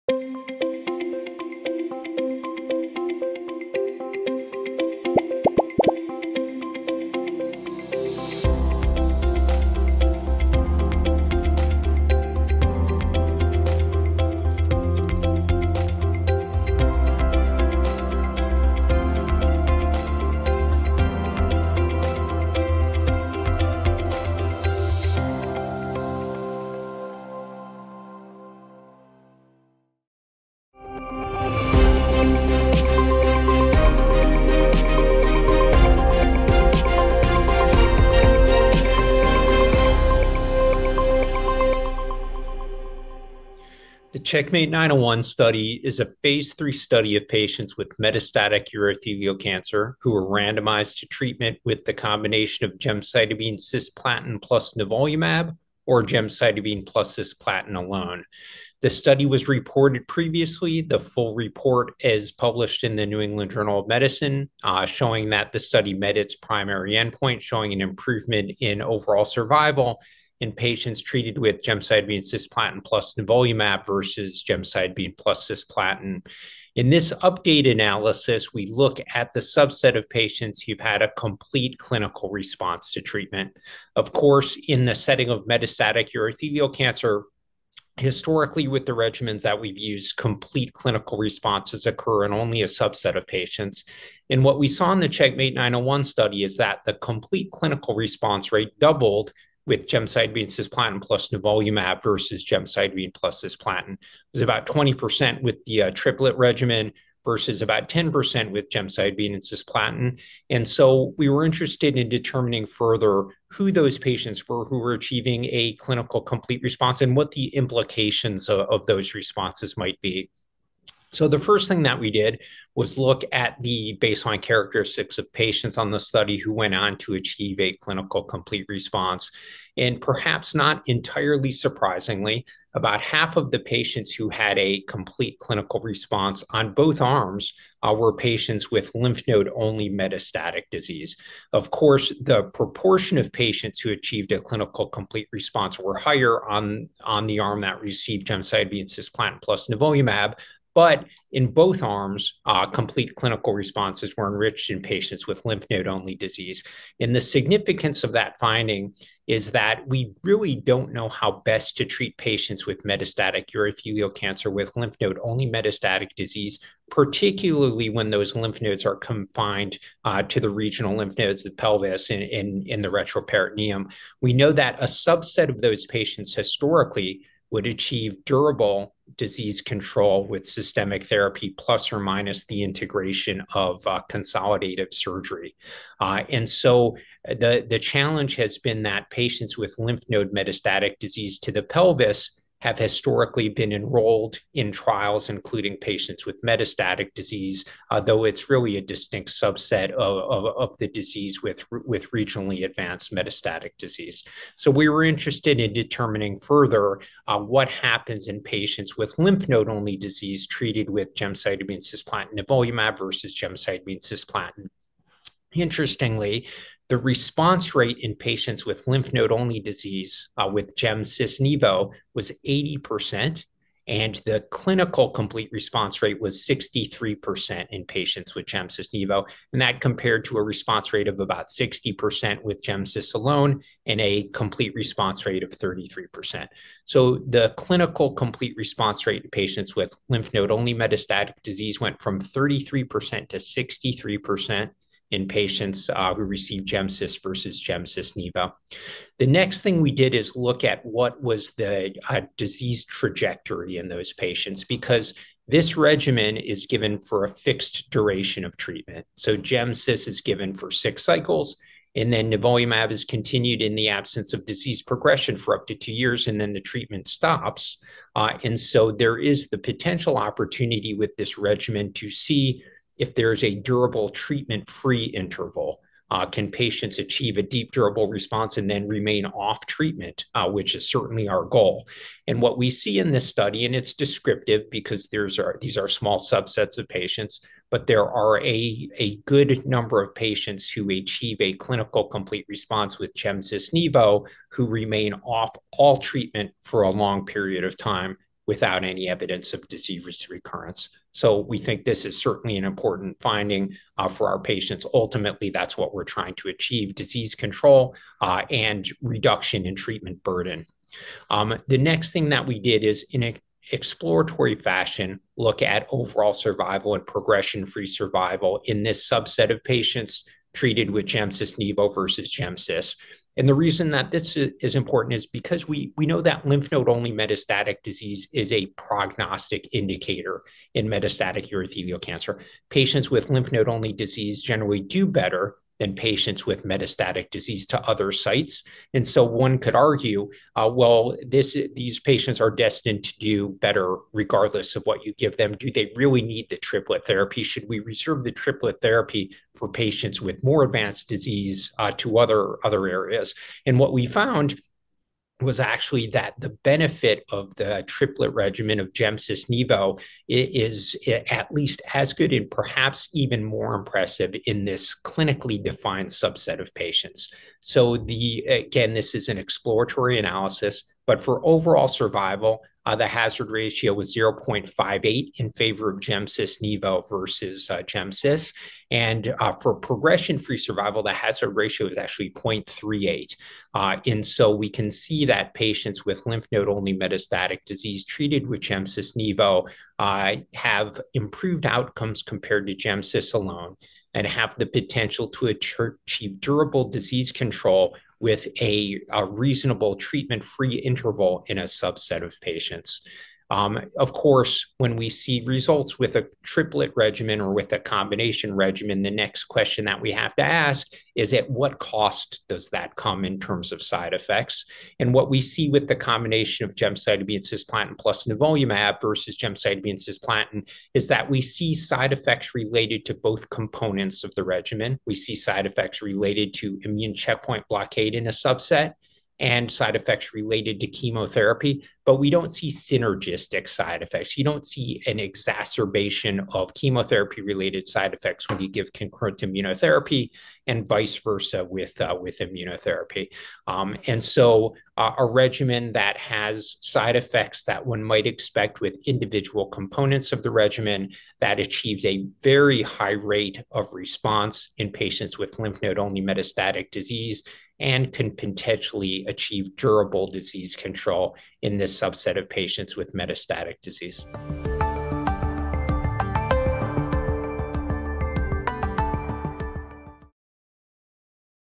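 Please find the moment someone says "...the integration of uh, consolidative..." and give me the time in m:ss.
3:02.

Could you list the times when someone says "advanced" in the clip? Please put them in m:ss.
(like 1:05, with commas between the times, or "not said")
3:22, 5:50.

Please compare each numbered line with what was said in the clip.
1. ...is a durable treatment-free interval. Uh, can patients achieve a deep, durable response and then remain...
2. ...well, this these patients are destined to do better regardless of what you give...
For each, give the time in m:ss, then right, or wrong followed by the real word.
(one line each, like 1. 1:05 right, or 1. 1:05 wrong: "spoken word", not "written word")
1. 4:33 right
2. 5:40 right.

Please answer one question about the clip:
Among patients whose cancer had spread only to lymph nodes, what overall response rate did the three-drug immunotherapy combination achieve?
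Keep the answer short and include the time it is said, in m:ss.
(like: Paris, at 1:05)
80%, at 3:42.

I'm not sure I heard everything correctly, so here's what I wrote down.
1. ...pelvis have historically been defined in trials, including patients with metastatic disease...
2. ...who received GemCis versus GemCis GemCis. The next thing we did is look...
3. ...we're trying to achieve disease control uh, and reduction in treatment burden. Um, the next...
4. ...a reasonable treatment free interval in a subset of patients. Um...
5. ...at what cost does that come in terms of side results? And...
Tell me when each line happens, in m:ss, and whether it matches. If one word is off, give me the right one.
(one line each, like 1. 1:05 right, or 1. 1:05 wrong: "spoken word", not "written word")
1. 3:11 wrong: "enrolled", not "defined"
2. 4:06 wrong: "Nivo", not "GemCis"
3. 5:05 right
4. 6:39 right
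5. 6:51 wrong: "effects", not "results".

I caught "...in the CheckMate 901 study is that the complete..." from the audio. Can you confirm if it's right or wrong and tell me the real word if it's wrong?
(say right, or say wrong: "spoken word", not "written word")
right.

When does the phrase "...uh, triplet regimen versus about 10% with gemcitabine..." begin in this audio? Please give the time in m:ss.
1:45.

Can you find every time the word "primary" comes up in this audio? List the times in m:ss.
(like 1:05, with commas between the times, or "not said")
1:06.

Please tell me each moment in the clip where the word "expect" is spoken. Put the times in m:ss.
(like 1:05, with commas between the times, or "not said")
7:28.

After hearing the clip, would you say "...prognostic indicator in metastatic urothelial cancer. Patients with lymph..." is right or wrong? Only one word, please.
right.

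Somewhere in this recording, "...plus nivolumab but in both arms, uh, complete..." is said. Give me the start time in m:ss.
2:29.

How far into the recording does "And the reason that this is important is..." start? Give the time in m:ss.
5:23.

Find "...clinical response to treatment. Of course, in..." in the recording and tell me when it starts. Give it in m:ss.
1:21.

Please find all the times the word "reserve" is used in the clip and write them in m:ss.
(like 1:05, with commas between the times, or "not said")
5:47.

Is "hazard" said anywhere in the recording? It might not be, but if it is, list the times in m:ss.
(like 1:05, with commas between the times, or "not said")
6:13, 6:21.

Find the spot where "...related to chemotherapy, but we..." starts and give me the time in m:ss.
7:10.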